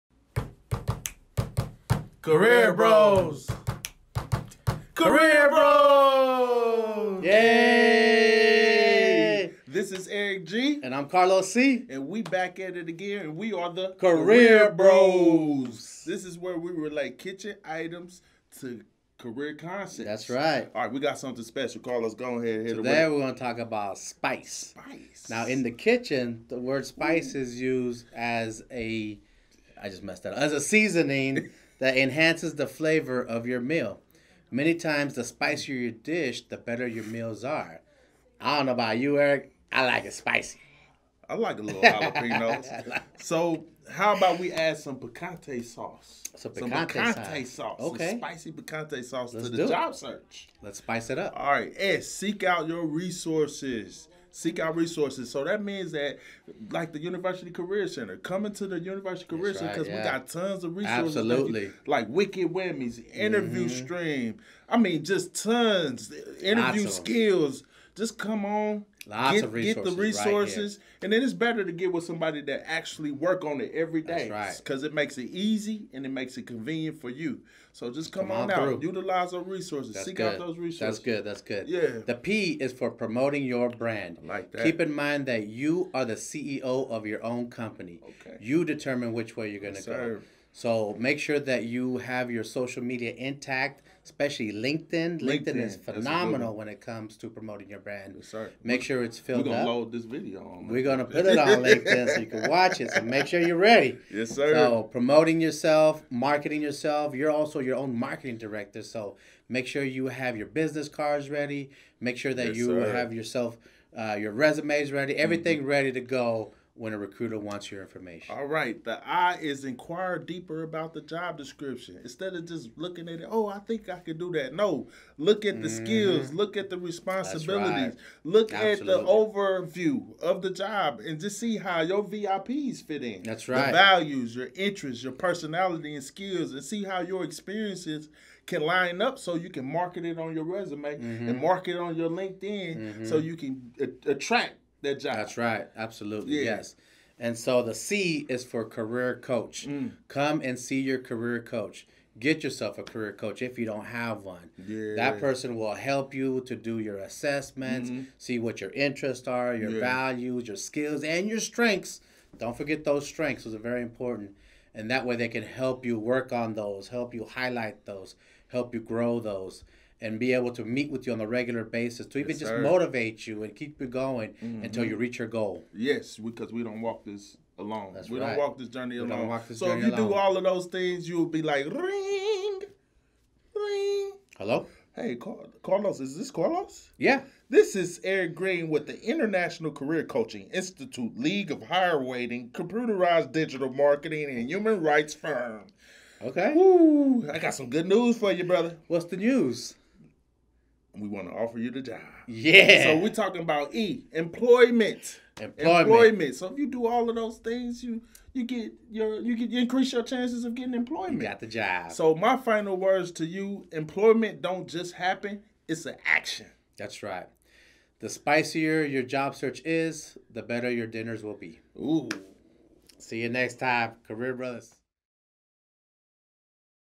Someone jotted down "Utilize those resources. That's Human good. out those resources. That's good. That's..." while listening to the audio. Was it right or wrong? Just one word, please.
wrong.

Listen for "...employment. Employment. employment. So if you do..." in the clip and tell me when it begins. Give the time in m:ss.
3:24.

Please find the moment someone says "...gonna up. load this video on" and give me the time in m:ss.
1:39.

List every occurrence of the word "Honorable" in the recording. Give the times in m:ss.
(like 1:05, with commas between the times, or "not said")
not said.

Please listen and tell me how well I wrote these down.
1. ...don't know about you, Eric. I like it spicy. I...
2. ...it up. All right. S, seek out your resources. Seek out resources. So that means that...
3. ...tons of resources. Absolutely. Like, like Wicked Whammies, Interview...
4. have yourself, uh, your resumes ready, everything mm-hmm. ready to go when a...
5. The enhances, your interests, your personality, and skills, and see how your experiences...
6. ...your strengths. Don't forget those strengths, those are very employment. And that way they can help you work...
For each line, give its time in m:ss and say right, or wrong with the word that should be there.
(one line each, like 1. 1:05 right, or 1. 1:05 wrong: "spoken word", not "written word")
1. 0:38 right
2. 0:51 right
3. 1:00 right
4. 1:52 right
5. 2:13 wrong: "values", not "enhances"
6. 2:41 wrong: "important", not "employment".